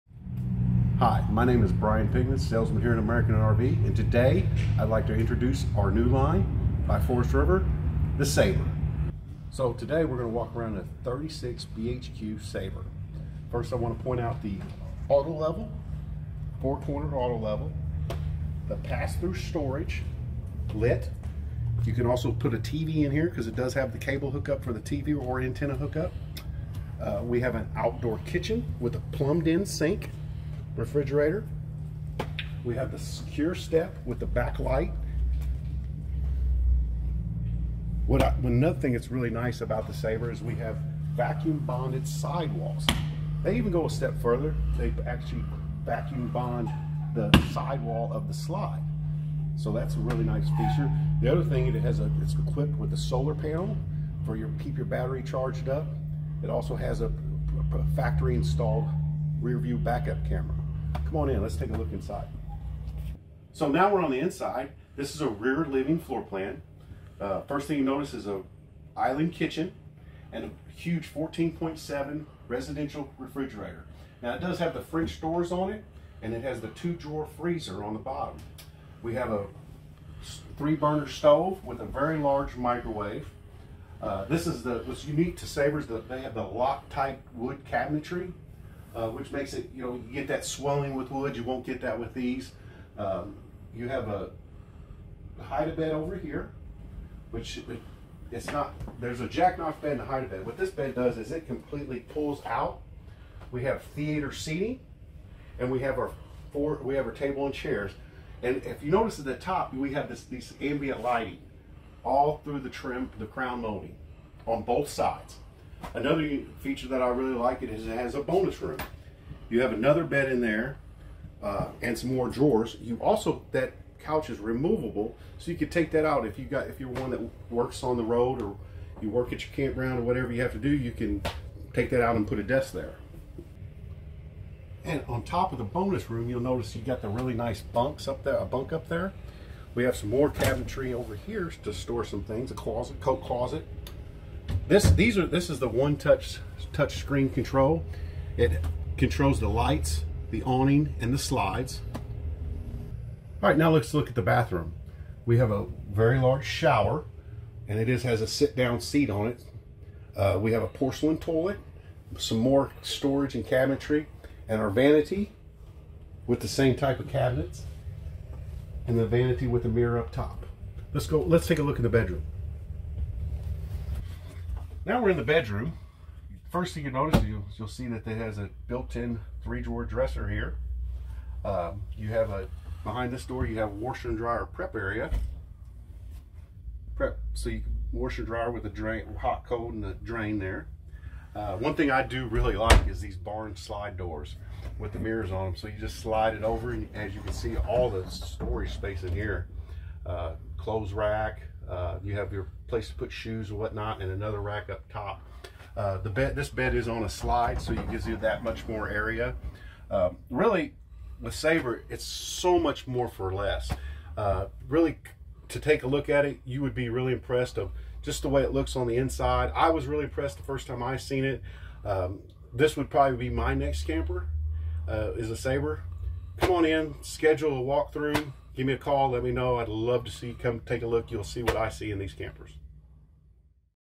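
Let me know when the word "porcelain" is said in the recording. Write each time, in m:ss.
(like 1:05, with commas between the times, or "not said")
2:40.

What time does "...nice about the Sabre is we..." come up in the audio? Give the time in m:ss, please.
0:39.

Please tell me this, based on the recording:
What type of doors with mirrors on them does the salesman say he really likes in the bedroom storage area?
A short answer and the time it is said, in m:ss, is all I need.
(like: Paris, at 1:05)
barn slide doors, at 3:13.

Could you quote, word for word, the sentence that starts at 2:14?
And on top of the bonus room, you'll notice you got the really nice bunks up there, a bunk up there.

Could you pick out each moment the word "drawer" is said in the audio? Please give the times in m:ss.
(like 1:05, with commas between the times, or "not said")
1:16, 2:02, 2:59.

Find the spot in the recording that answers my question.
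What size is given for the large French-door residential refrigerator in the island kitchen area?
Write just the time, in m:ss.
1:11.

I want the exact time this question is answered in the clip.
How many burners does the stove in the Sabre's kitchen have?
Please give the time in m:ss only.
1:20.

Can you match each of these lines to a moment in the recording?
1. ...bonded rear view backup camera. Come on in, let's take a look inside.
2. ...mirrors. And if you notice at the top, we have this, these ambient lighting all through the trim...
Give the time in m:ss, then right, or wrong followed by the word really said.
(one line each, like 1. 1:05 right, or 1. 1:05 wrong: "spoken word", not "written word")
1. 0:58 wrong: "installed", not "bonded"
2. 1:47 wrong: "chairs", not "mirrors".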